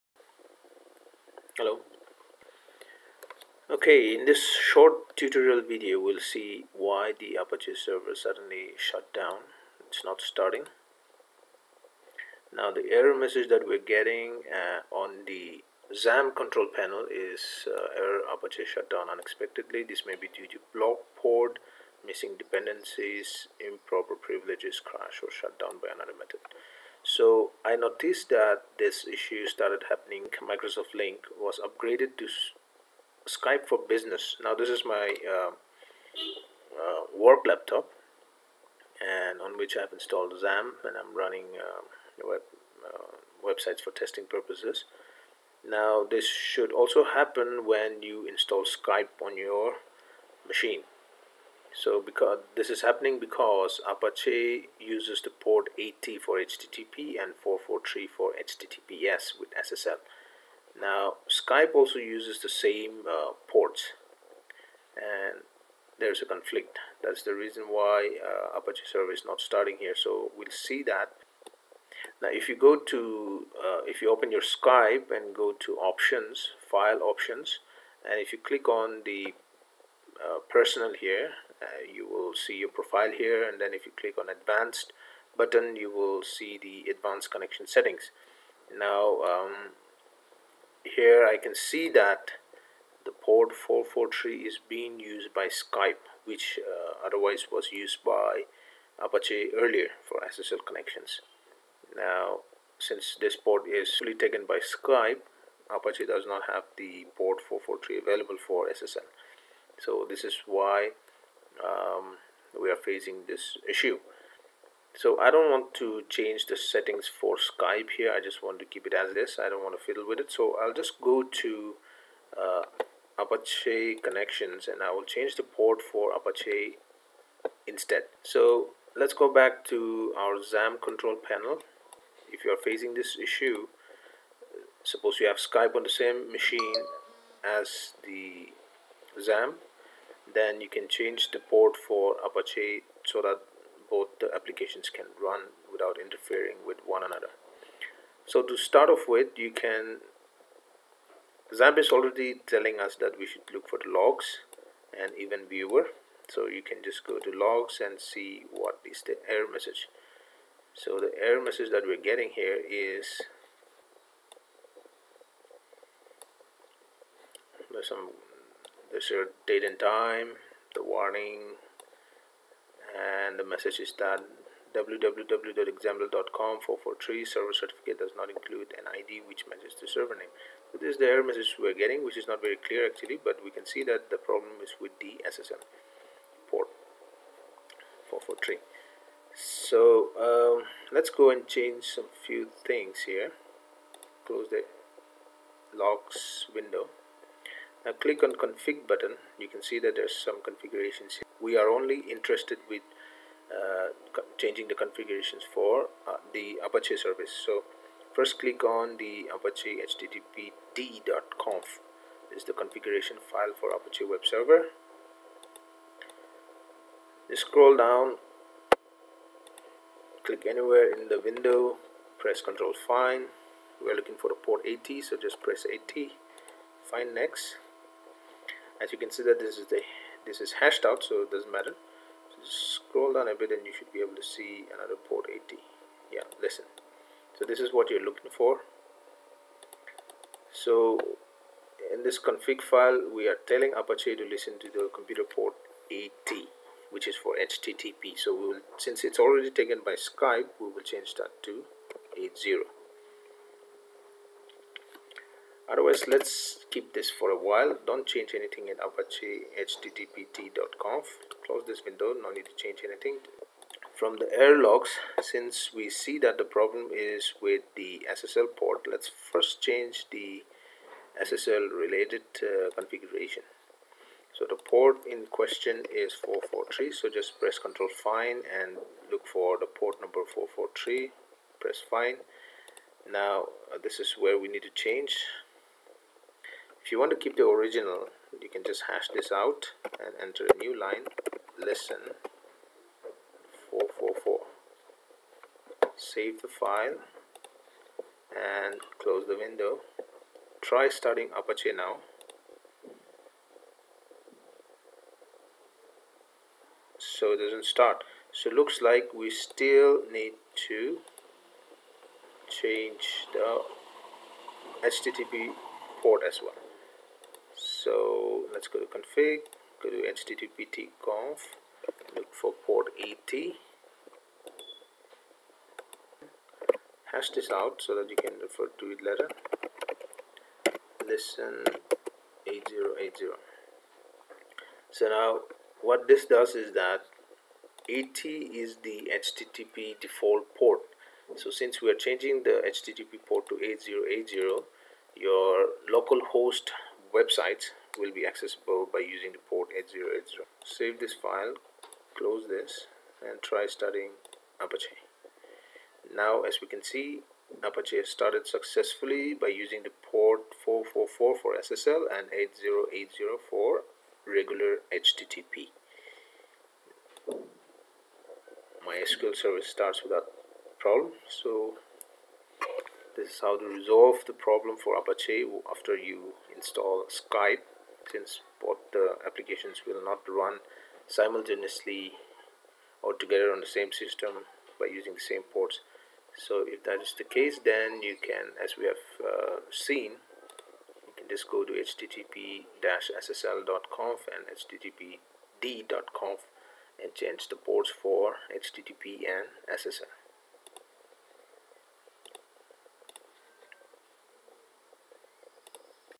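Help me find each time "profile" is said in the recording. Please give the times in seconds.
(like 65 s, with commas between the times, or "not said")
82 s.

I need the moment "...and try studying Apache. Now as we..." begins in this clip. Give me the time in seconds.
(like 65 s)
353 s.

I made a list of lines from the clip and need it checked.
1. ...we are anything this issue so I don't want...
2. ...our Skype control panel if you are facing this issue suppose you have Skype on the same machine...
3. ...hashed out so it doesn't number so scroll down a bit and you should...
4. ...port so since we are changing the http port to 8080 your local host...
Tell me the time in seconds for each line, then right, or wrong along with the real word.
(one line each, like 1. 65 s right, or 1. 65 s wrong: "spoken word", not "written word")
1. 112 s wrong: "facing", not "anything"
2. 130 s wrong: "XAMPP", not "Skype"
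3. 230 s wrong: "matter", not "number"
4. 340 s right.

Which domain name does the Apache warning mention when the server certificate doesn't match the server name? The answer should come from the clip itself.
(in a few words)
www.example.com.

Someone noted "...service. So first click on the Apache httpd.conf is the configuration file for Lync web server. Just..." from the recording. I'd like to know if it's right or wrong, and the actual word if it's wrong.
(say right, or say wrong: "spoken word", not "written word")
wrong: "Apache", not "Lync".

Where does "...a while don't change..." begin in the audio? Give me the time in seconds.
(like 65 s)
257 s.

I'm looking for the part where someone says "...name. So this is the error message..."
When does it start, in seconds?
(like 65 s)
180 s.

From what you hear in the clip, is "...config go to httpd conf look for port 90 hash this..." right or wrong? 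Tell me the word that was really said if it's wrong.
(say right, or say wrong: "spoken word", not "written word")
wrong: "80", not "90".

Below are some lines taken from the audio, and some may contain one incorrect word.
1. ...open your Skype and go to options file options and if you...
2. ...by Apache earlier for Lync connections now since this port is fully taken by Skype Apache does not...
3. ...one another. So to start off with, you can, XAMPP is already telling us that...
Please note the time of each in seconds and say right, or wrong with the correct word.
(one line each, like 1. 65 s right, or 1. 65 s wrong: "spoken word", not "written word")
1. 74 s right
2. 98 s wrong: "SSL", not "Lync"
3. 146 s right.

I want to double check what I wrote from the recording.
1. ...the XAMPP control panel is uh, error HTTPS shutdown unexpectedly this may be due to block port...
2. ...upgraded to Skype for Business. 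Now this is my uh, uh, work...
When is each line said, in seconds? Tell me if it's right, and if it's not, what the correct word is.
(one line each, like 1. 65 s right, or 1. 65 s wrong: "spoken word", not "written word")
1. 15 s wrong: "Apache", not "HTTPS"
2. 31 s right.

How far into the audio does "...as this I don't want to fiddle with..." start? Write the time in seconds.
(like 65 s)
118 s.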